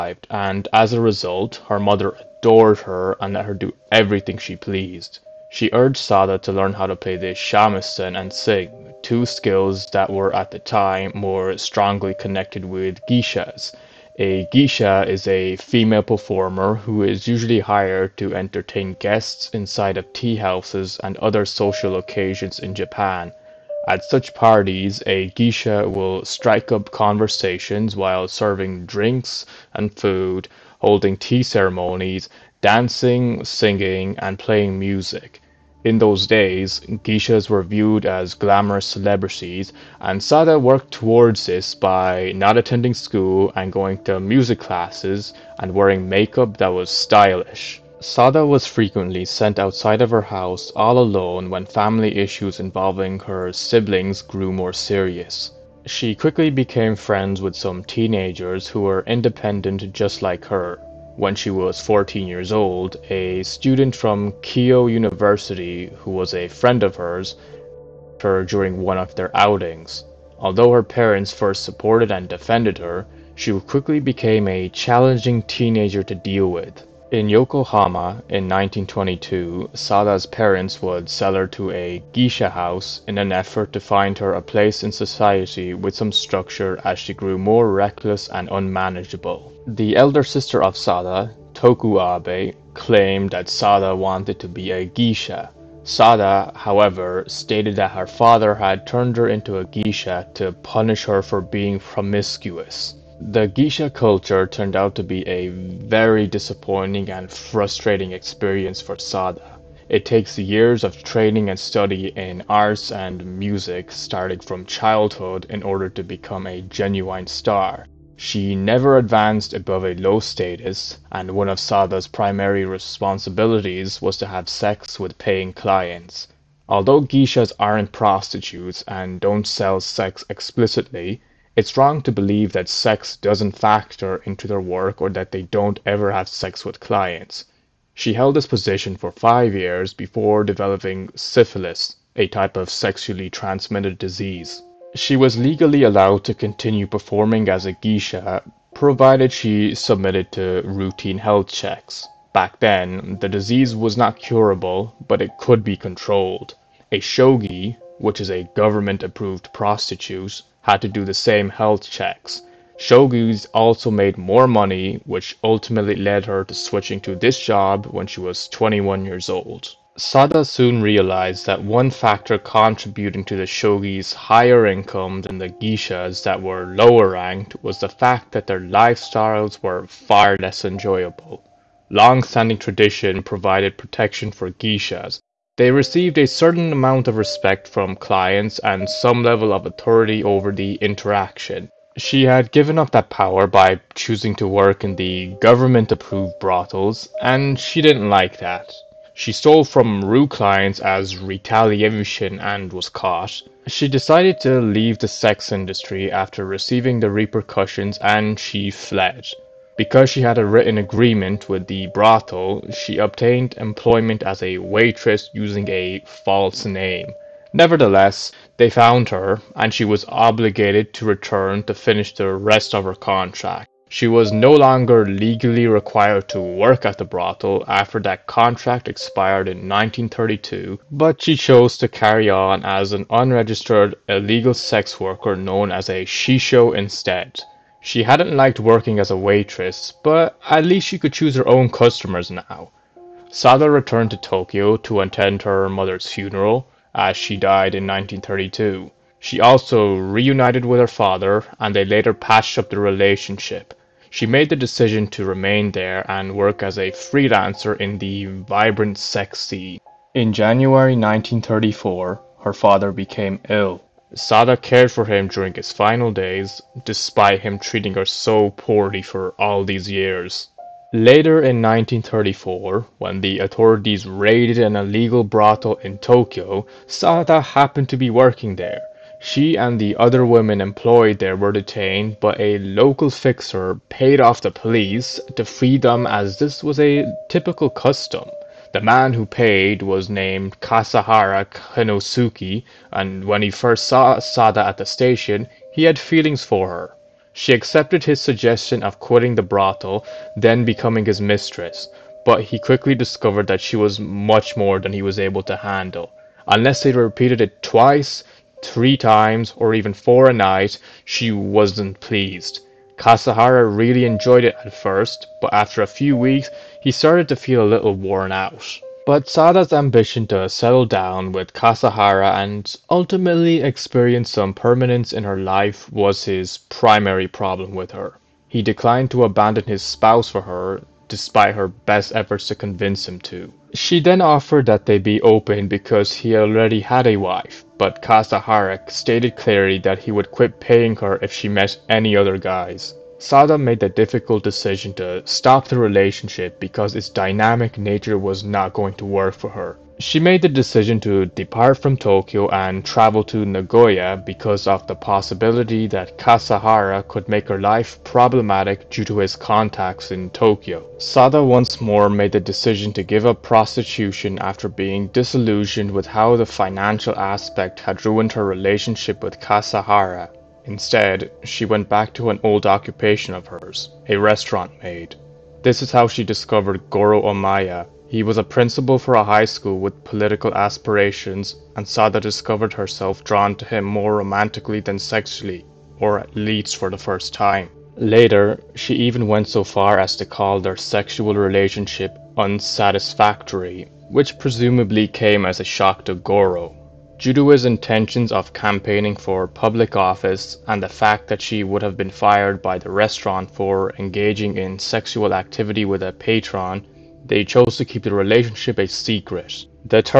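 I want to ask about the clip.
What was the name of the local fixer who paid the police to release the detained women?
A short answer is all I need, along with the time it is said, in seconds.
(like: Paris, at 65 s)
Kasahara Kinnosuke, at 290 s.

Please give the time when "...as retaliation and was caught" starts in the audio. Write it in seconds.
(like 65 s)
200 s.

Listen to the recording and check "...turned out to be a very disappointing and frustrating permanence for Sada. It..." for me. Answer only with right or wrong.
wrong.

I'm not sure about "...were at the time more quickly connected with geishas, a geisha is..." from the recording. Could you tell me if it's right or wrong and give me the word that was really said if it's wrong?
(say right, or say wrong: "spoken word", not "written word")
wrong: "strongly", not "quickly".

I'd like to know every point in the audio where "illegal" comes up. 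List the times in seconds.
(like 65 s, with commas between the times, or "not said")
234 s, 274 s.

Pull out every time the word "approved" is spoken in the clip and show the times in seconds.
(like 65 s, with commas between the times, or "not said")
159 s, 195 s.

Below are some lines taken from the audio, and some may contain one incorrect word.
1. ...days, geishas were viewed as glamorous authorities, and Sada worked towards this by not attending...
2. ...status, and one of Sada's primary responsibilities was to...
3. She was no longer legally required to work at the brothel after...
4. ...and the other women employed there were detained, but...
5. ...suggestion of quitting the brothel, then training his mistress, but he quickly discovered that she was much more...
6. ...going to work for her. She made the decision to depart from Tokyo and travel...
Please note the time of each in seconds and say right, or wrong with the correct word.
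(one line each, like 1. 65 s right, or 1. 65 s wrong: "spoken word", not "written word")
1. 36 s wrong: "celebrities", not "authorities"
2. 120 s right
3. 223 s right
4. 279 s right
5. 298 s wrong: "becoming", not "training"
6. 348 s right.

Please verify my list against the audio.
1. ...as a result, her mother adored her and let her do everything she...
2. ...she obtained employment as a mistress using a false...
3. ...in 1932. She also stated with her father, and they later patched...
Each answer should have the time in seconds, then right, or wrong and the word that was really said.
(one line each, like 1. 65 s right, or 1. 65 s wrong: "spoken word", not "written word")
1. 0 s right
2. 212 s wrong: "waitress", not "mistress"
3. 247 s wrong: "reunited", not "stated".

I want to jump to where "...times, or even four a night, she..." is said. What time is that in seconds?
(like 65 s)
308 s.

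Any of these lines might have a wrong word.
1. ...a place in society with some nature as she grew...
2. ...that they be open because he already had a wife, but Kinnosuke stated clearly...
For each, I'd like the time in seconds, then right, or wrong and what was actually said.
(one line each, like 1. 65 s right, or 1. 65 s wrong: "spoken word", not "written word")
1. 84 s wrong: "structure", not "nature"
2. 334 s wrong: "Kasahara", not "Kinnosuke".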